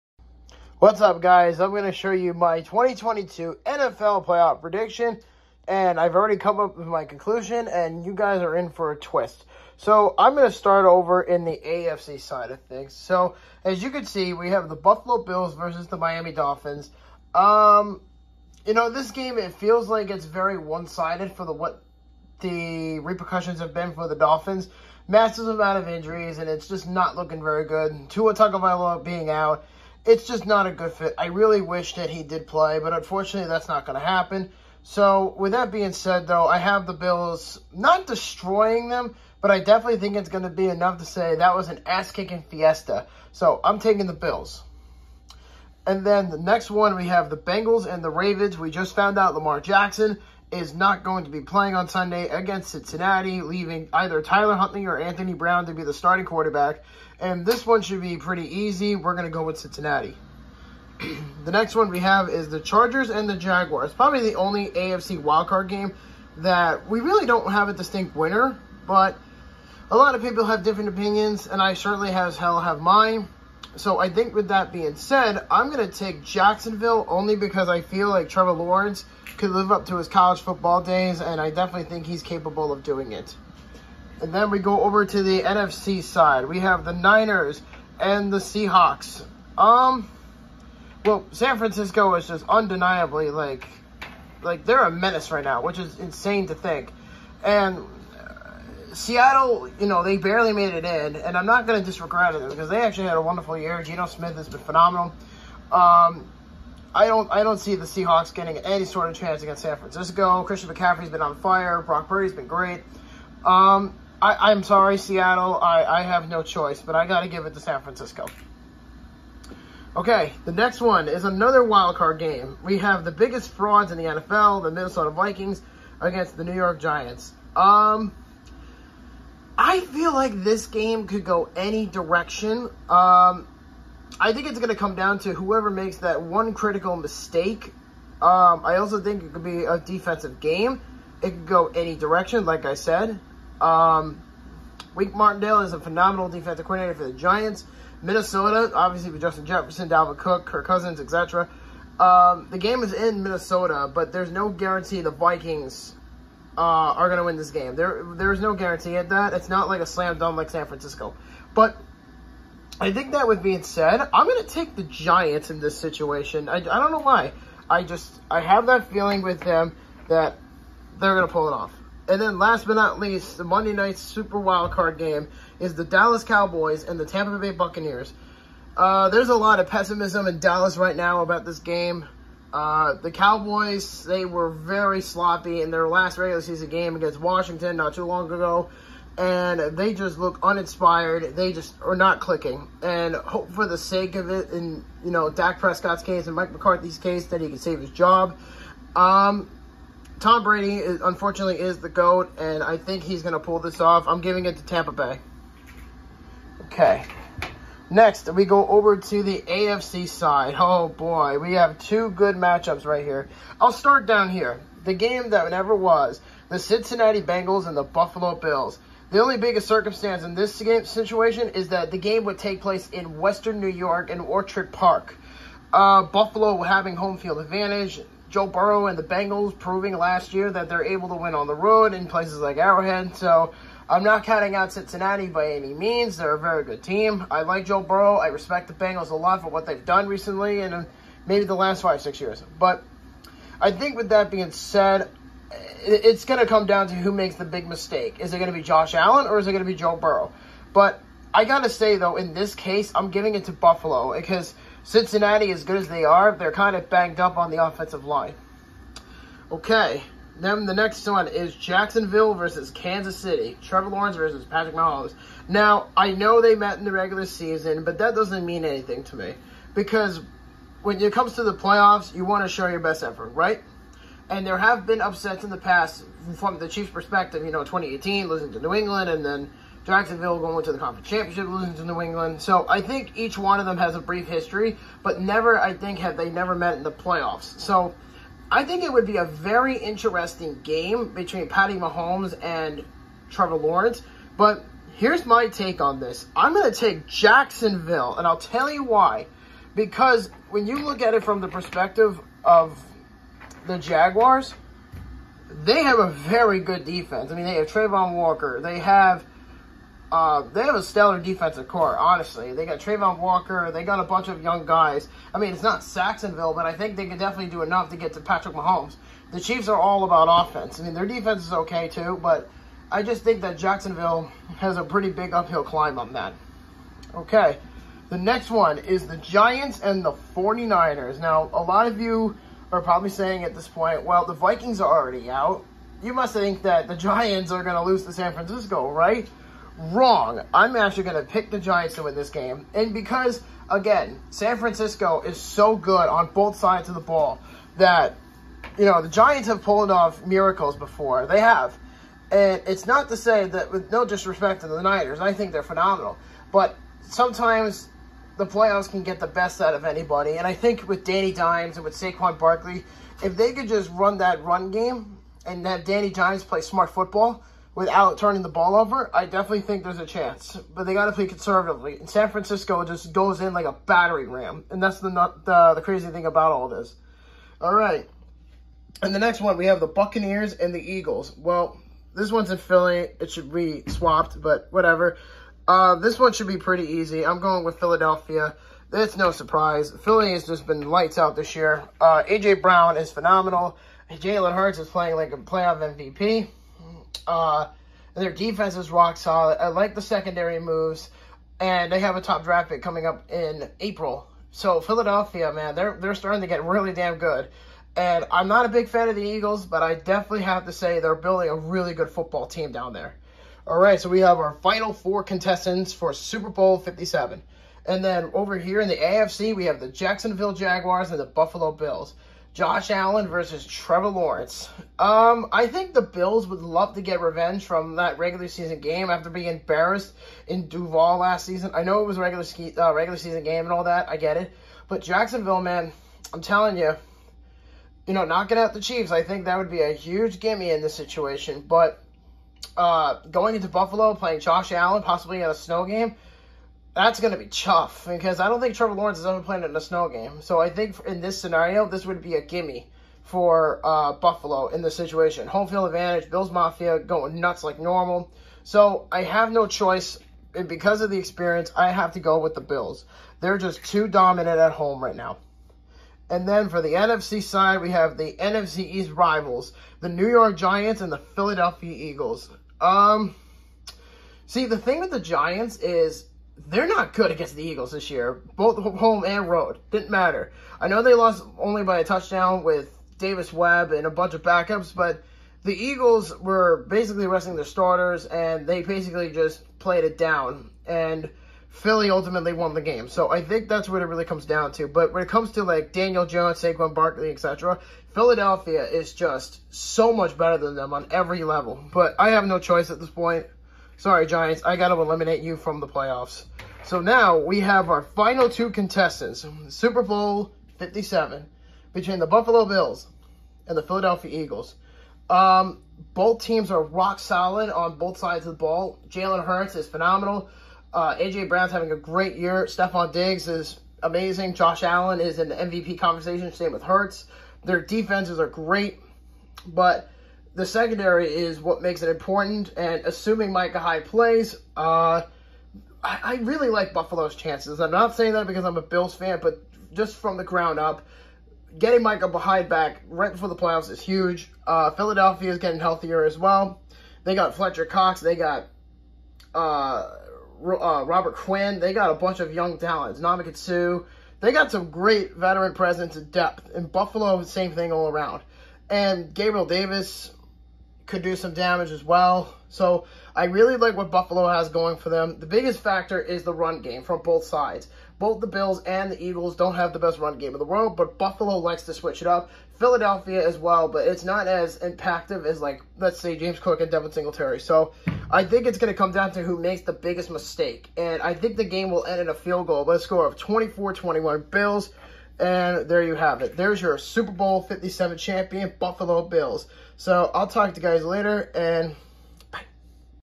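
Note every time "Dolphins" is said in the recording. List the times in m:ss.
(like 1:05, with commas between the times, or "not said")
0:16, 0:24.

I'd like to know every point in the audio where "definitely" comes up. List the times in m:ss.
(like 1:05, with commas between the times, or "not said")
0:39, 1:21, 5:17, 6:09, 6:49.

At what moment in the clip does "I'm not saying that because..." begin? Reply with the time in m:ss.
8:57.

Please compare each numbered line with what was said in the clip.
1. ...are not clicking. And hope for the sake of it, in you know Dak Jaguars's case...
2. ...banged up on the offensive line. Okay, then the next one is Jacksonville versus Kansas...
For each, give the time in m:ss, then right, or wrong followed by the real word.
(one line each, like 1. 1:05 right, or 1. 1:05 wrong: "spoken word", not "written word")
1. 3:11 wrong: "Prescott", not "Jaguars"
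2. 4:16 right.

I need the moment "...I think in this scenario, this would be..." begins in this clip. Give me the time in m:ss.
7:30.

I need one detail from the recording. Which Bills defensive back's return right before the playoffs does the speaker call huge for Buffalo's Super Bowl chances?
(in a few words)
Micah Hyde.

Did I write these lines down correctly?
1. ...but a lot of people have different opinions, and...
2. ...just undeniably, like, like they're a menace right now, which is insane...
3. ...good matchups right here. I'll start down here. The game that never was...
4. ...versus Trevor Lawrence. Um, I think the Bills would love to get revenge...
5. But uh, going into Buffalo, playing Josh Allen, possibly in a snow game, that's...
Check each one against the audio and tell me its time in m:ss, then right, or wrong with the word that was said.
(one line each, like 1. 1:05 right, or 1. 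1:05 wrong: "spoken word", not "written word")
1. 1:08 right
2. 1:32 right
3. 3:32 right
4. 7:03 right
5. 7:21 right.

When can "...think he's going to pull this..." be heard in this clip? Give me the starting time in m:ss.
3:22.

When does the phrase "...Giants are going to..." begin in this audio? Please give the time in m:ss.
5:36.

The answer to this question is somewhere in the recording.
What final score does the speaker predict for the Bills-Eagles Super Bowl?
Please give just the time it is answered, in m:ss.
9:43.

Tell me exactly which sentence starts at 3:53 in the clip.
So I'm not counting out Cincinnati by any means.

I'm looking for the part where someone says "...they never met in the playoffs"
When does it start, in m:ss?
4:46.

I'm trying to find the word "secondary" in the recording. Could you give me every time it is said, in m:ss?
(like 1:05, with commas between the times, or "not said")
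6:40, 8:50.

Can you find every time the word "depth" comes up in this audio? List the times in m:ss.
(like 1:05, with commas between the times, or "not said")
9:16.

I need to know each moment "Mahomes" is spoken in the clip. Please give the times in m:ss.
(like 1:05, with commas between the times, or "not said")
4:24, 4:51, 5:18.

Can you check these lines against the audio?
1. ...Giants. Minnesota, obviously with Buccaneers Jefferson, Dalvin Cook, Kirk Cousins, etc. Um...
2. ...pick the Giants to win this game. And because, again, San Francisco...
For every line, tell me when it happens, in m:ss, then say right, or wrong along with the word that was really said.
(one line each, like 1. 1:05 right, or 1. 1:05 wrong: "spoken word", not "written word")
1. 2:27 wrong: "Justin", not "Buccaneers"
2. 5:41 right.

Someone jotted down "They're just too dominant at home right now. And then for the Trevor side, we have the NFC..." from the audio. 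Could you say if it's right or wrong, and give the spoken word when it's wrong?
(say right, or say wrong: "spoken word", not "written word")
wrong: "NFC", not "Trevor".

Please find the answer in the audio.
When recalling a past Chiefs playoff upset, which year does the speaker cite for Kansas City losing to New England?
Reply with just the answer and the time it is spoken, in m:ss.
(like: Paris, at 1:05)
2018, at 4:37.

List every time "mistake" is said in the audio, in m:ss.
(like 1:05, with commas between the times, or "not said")
2:16, 4:07, 9:40.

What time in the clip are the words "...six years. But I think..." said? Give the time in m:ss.
4:01.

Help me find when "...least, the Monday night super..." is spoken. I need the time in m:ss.
2:52.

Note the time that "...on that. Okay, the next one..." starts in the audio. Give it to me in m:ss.
5:25.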